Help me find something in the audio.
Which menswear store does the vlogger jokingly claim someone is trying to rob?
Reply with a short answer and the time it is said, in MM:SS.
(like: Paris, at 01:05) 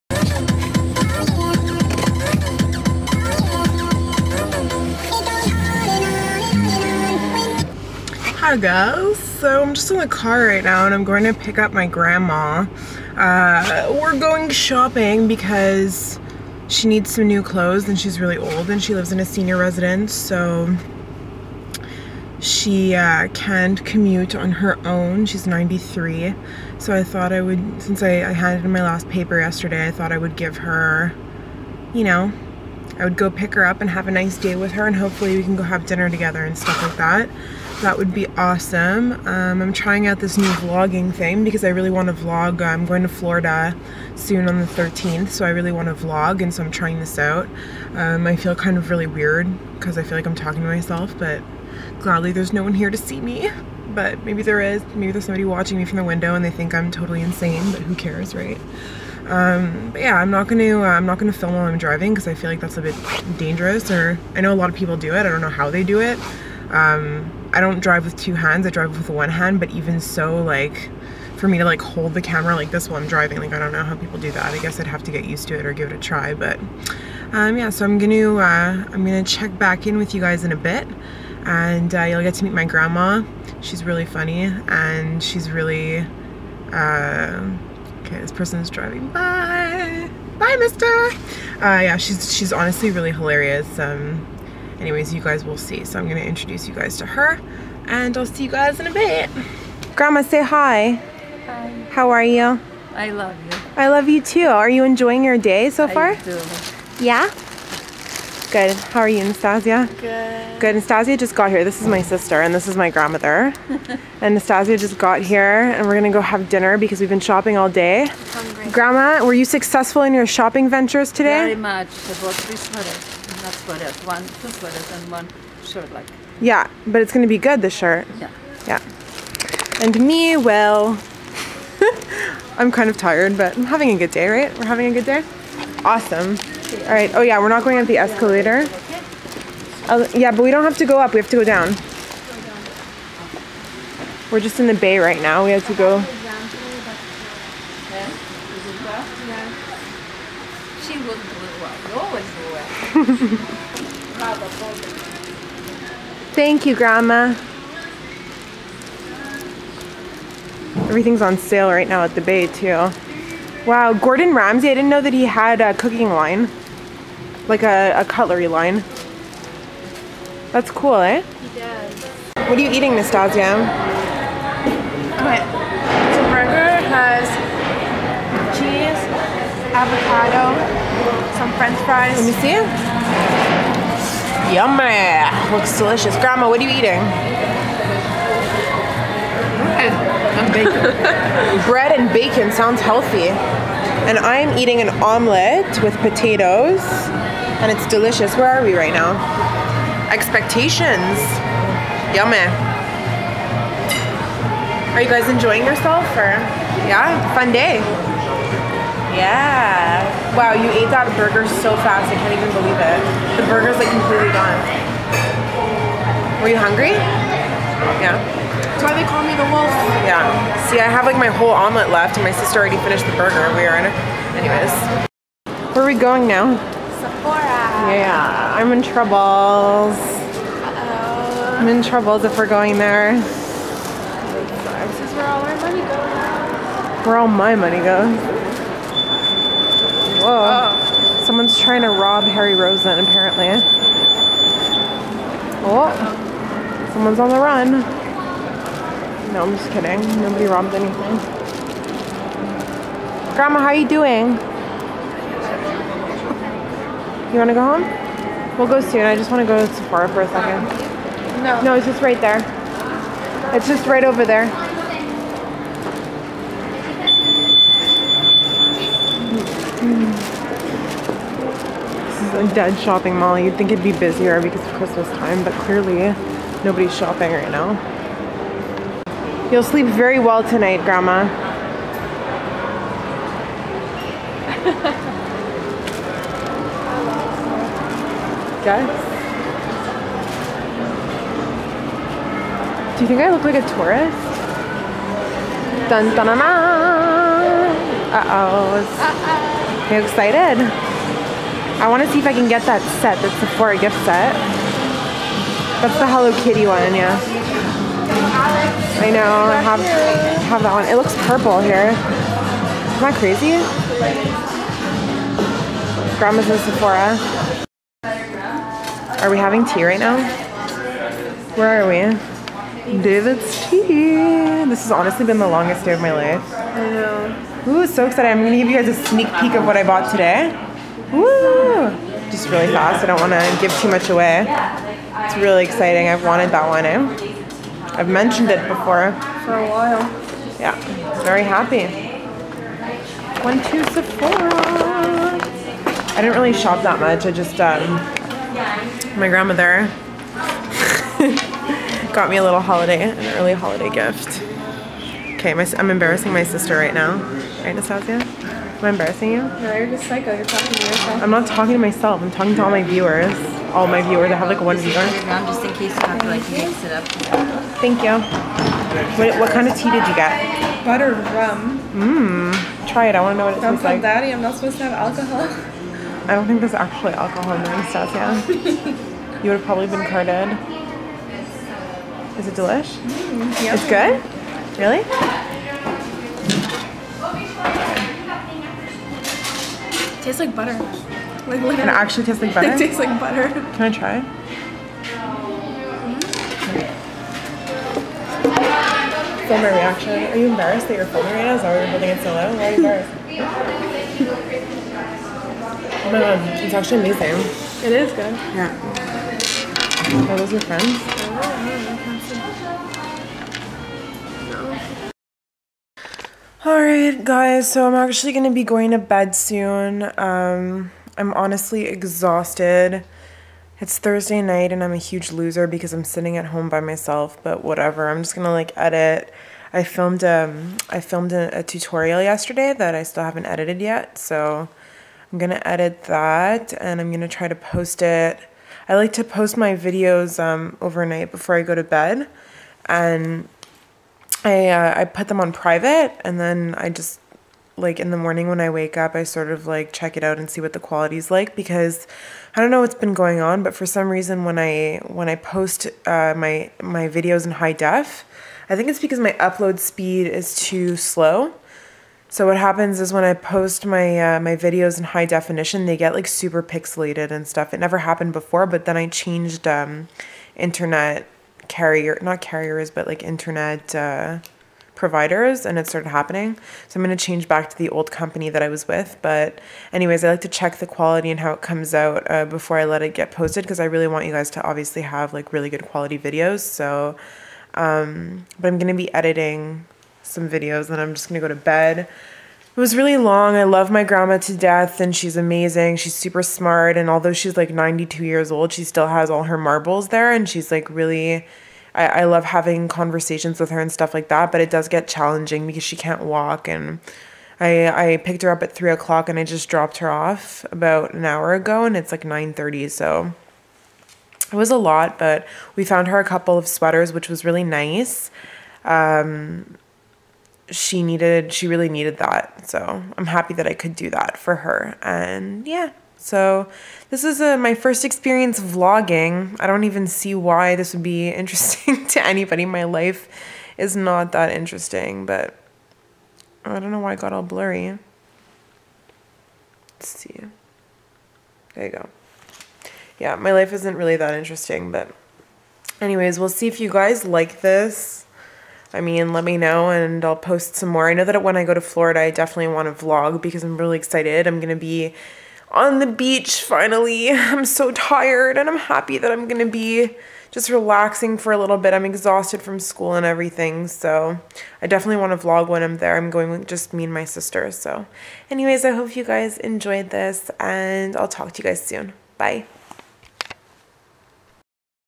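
Harry Rosen, at 04:02.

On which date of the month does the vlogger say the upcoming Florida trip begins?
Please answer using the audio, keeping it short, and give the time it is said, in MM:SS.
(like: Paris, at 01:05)
13th, at 00:44.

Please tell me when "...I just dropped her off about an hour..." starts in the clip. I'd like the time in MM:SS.
08:29.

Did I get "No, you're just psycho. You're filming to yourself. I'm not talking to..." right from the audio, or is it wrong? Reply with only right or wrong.
wrong.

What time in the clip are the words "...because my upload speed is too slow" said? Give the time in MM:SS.
07:38.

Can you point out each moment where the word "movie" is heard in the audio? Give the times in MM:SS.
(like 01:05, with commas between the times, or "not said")
not said.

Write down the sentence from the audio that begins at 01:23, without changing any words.
She's really funny and she's really.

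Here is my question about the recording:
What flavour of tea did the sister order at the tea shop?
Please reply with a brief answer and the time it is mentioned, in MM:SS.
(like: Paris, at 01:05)
Butter rum, at 06:10.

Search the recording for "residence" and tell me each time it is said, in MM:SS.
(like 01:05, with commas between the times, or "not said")
00:19.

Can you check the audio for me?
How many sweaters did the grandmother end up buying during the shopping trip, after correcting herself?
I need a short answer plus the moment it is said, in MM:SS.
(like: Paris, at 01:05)
2, at 02:04.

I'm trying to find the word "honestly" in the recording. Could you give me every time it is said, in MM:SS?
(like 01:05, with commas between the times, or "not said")
01:32, 05:24, 07:01.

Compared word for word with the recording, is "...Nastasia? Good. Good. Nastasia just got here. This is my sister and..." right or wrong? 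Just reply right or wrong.
right.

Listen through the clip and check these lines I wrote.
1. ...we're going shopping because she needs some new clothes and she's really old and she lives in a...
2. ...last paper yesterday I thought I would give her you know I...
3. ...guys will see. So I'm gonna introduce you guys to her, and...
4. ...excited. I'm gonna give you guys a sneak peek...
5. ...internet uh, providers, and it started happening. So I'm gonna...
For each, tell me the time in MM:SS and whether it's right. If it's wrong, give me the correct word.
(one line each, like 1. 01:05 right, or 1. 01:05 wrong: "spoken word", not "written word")
1. 00:14 right
2. 00:28 right
3. 01:35 right
4. 05:28 right
5. 07:53 right.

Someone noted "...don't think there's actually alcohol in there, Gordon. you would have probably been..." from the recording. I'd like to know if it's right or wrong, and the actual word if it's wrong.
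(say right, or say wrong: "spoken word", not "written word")
wrong: "Anastasia", not "Gordon".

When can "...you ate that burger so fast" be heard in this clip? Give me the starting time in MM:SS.
03:30.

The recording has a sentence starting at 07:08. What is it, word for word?
I'm just going to like edit.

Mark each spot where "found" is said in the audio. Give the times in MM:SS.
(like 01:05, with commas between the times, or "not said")
08:35.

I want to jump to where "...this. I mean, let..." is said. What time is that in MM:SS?
09:07.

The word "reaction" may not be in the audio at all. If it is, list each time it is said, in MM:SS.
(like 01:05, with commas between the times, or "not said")
06:39.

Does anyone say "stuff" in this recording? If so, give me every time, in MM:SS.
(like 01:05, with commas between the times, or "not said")
00:36, 07:47, 08:23.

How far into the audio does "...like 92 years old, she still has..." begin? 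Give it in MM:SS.
08:17.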